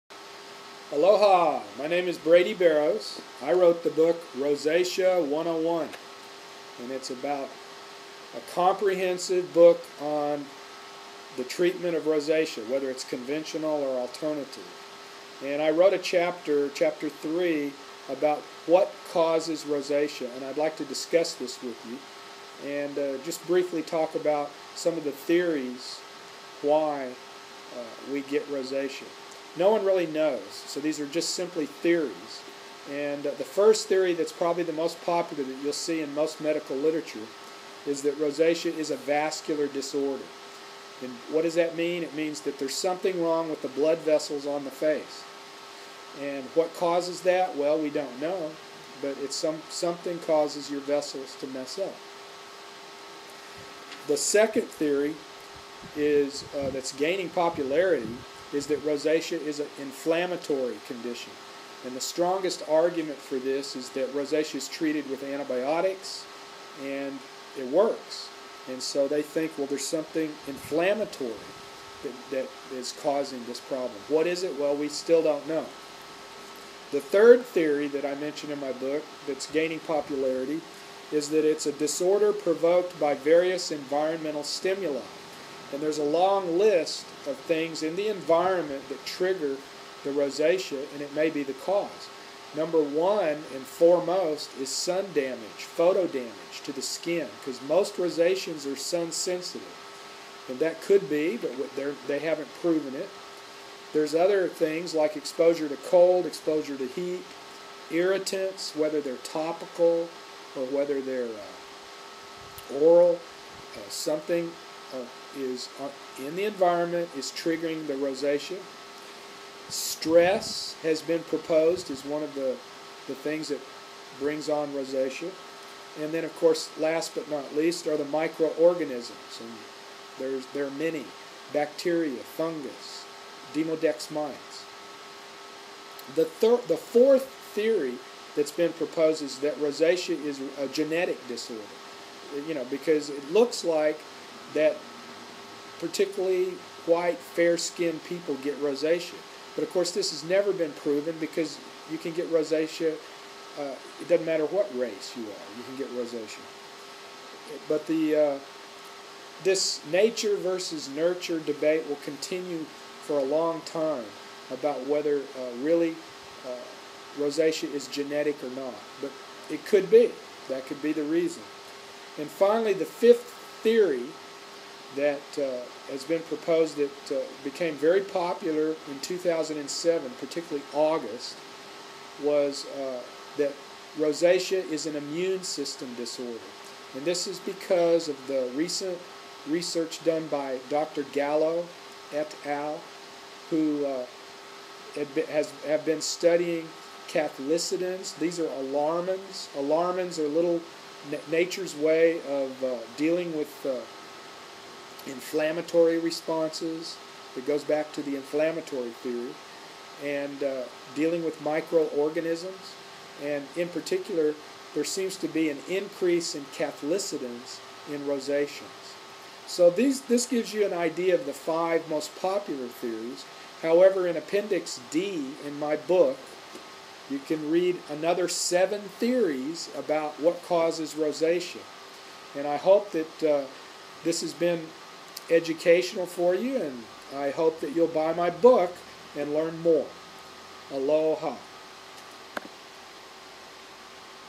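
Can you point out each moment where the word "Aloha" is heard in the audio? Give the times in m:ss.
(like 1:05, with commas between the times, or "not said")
0:00, 4:00.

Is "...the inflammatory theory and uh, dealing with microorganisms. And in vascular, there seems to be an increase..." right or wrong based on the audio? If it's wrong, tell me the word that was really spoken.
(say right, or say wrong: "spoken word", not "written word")
wrong: "particular", not "vascular".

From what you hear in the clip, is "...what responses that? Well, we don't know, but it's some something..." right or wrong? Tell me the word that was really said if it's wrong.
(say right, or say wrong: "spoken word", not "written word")
wrong: "causes", not "responses".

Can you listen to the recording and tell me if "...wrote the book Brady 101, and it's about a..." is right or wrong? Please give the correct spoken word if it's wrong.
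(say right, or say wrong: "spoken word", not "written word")
wrong: "Rosacea", not "Brady".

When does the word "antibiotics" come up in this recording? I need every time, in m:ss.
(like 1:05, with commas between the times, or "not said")
1:05.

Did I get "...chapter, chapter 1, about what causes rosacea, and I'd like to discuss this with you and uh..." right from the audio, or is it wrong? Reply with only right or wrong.
wrong.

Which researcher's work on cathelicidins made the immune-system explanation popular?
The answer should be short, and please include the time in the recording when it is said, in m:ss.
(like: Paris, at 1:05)
Dr. Gallo, at 3:10.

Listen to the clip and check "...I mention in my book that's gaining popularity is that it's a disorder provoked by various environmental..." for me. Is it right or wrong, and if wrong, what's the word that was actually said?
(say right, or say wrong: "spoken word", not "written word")
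right.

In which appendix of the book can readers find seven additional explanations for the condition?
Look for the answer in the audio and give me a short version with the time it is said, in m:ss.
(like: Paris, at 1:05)
Appendix D, at 3:44.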